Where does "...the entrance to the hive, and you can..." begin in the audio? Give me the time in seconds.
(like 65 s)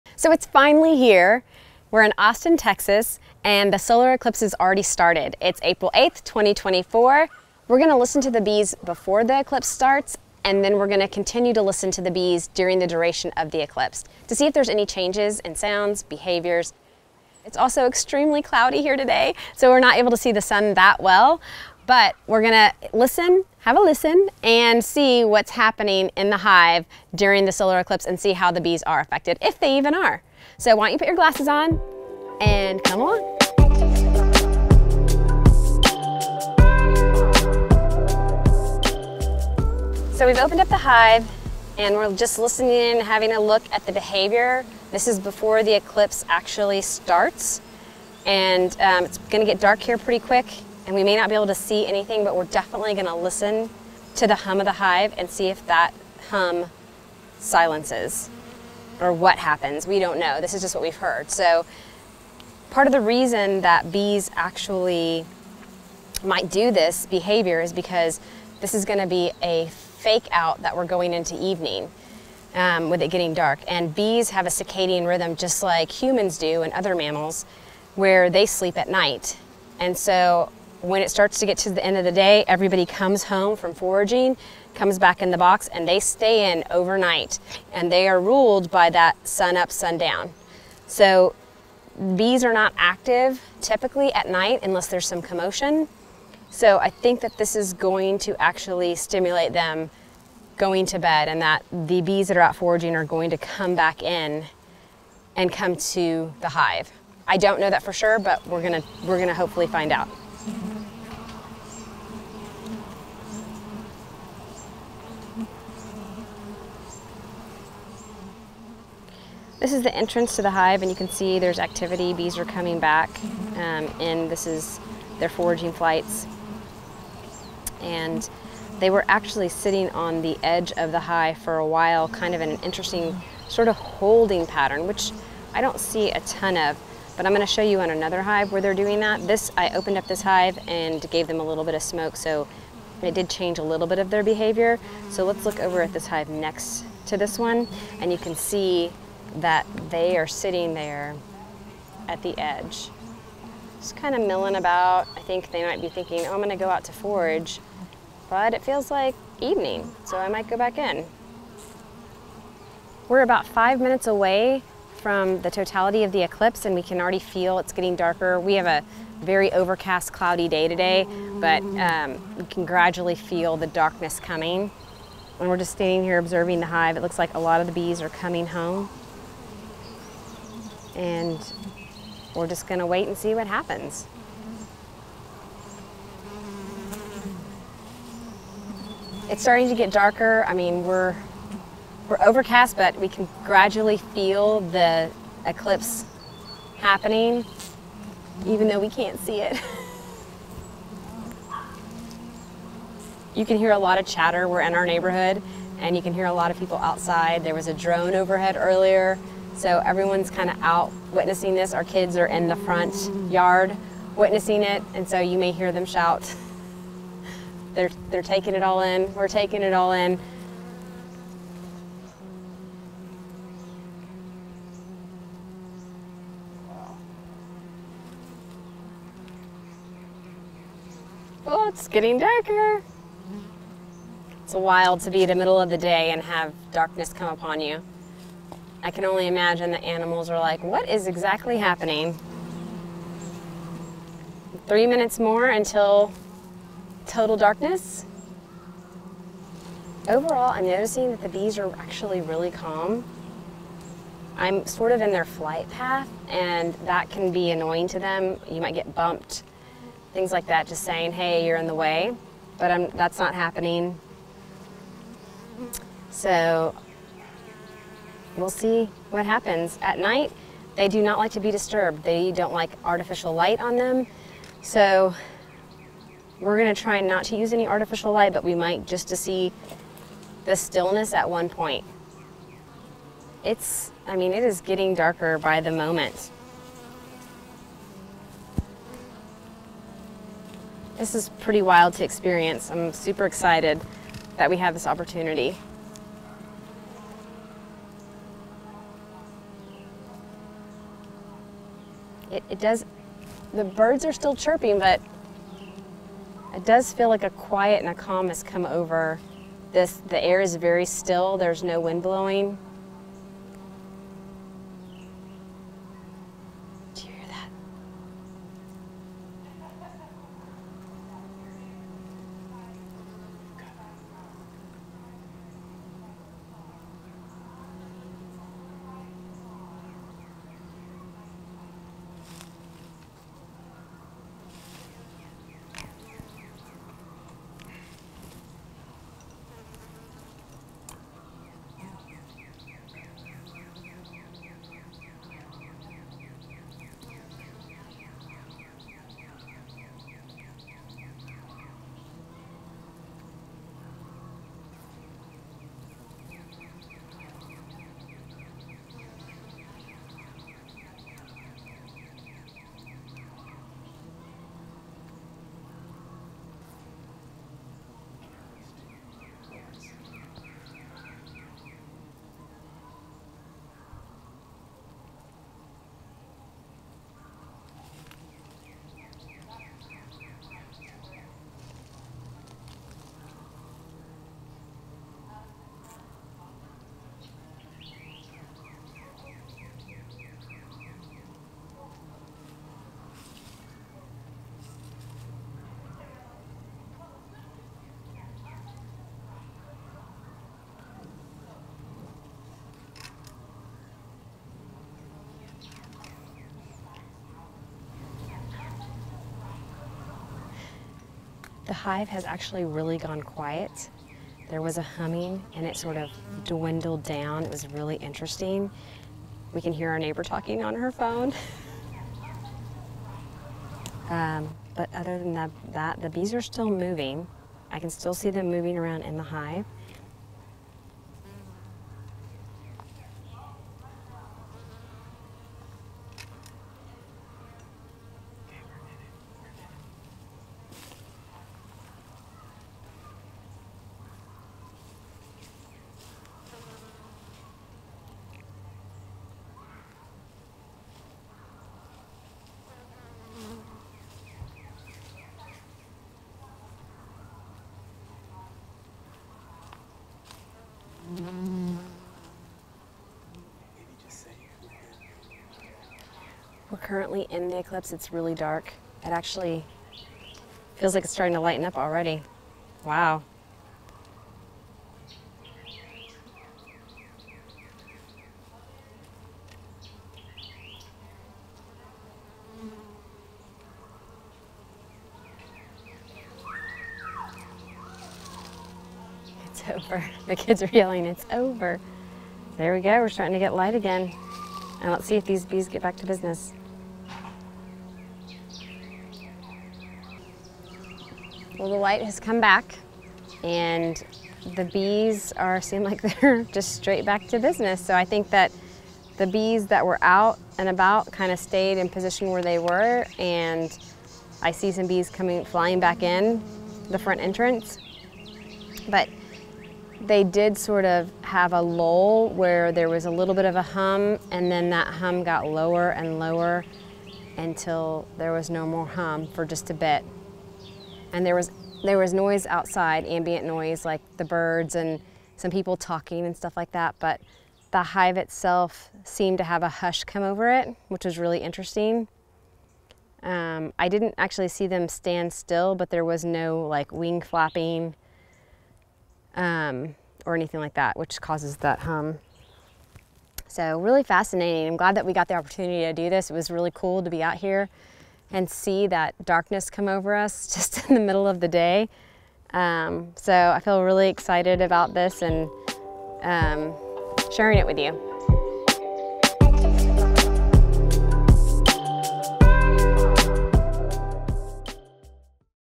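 119 s.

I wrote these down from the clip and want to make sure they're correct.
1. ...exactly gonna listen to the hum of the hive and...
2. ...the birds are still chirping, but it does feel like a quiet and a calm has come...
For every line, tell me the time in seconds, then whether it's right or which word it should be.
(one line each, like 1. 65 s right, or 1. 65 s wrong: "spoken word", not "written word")
1. 52 s wrong: "definitely", not "exactly"
2. 303 s right.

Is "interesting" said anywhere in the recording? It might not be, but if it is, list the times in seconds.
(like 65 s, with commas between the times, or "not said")
132 s, 417 s, 541 s.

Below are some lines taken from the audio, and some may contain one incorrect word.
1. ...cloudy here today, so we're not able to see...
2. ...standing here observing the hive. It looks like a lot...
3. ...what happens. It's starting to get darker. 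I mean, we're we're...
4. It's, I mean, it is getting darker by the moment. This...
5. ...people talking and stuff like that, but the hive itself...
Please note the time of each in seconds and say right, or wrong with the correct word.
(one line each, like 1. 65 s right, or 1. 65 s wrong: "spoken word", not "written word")
1. 18 s right
2. 175 s right
3. 183 s right
4. 283 s right
5. 535 s right.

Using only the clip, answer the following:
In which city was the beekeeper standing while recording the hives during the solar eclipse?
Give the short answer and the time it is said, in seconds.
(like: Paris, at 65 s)
Austin, Texas, at 2 s.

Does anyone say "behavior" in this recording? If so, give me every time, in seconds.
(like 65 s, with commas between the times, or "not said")
16 s, 43 s, 67 s, 144 s.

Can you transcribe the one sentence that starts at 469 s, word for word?
It actually feels like it's starting to lighten up already.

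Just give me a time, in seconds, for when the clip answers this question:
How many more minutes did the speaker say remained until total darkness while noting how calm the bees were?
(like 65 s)
244 s.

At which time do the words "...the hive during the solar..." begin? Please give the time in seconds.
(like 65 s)
26 s.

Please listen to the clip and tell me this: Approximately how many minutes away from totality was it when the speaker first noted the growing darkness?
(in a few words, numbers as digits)
5.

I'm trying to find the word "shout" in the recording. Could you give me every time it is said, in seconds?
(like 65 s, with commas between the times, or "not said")
215 s.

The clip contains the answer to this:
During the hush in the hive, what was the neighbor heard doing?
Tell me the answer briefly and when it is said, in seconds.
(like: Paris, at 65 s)
talking on her phone, at 420 s.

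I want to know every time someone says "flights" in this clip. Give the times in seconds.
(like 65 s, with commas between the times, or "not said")
125 s, 255 s.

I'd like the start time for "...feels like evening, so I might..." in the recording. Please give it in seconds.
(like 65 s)
158 s.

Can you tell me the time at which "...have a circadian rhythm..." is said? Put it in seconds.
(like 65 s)
74 s.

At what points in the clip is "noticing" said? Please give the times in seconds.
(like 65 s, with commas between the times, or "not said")
250 s.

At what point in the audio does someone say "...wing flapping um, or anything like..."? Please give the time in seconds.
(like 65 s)
546 s.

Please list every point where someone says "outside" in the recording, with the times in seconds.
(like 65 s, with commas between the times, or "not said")
206 s, 532 s.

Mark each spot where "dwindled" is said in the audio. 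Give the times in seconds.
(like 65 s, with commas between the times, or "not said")
416 s.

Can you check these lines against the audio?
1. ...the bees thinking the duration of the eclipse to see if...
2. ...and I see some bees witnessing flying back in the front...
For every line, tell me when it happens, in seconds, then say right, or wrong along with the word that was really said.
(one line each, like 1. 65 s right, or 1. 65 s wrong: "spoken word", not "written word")
1. 12 s wrong: "during", not "thinking"
2. 513 s wrong: "coming", not "witnessing".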